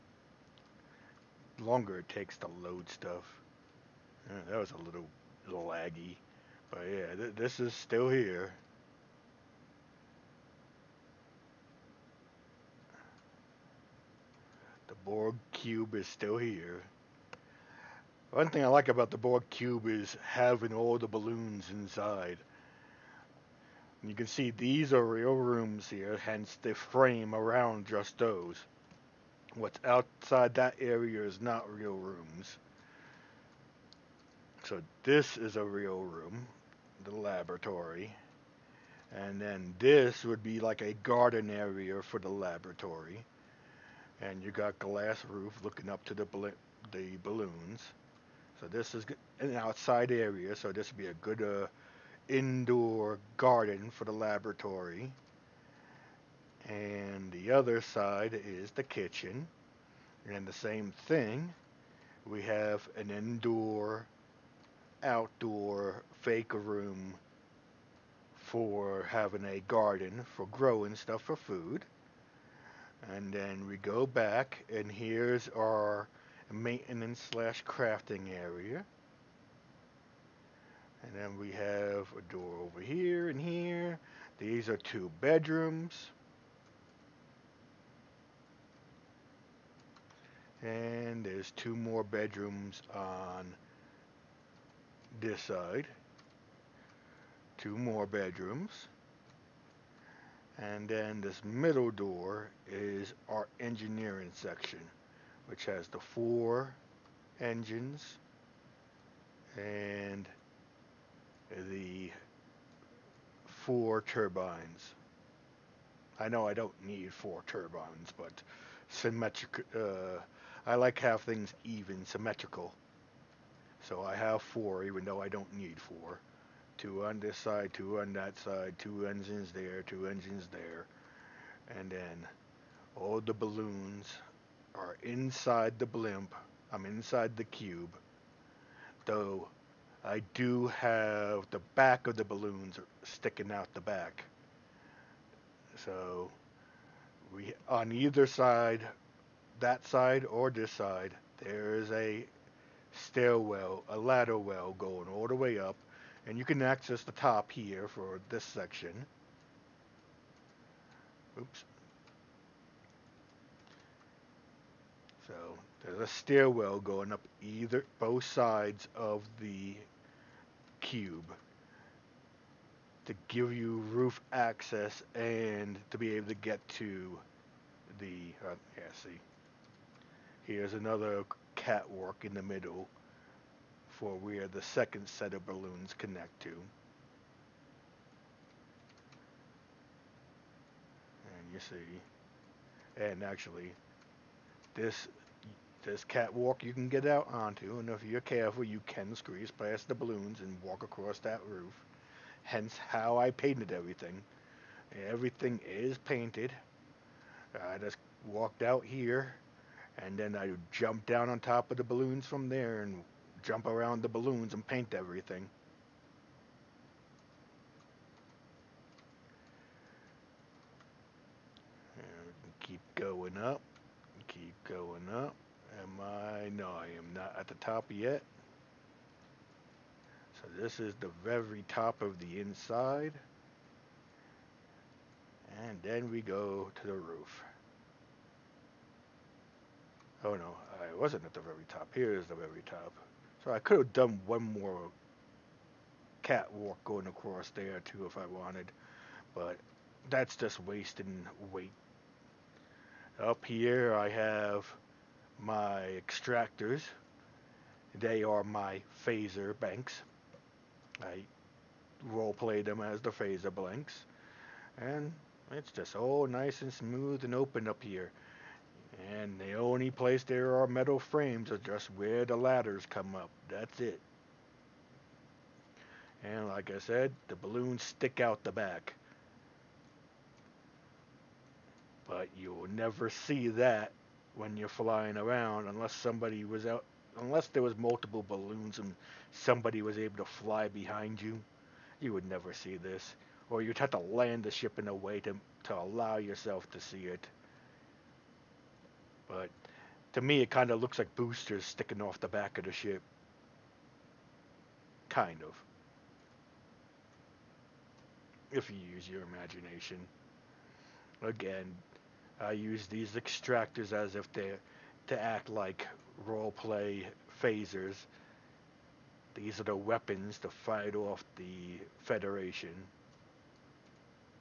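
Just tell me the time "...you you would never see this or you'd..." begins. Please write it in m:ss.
4:51.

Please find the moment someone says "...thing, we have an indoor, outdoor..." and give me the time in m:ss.
1:01.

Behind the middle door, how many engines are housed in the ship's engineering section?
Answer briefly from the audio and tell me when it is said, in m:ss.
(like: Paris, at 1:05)
4, at 1:45.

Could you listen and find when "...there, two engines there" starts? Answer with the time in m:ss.
2:09.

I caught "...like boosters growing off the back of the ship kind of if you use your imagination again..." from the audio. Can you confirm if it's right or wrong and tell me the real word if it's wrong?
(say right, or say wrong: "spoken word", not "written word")
wrong: "sticking", not "growing".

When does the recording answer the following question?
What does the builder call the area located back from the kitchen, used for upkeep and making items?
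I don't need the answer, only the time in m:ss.
1:16.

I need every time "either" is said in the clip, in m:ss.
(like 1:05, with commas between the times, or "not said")
2:27, 2:47.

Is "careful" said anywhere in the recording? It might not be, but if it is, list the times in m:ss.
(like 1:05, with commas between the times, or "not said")
3:18.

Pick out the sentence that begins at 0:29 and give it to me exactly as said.
What's outside that area is not real rooms.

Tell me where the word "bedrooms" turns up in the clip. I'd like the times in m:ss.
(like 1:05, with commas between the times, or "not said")
1:25, 1:32, 1:38.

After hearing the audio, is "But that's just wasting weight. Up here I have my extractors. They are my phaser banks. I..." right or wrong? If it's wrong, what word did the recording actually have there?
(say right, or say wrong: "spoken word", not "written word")
right.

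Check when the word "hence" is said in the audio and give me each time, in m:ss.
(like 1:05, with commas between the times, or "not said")
0:26, 3:22.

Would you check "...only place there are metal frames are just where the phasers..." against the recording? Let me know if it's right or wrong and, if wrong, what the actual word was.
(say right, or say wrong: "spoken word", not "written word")
wrong: "ladders", not "phasers".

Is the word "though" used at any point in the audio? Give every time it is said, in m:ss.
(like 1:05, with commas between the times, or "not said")
2:05, 2:19.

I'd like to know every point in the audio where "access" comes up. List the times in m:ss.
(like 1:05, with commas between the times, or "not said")
2:36, 2:54.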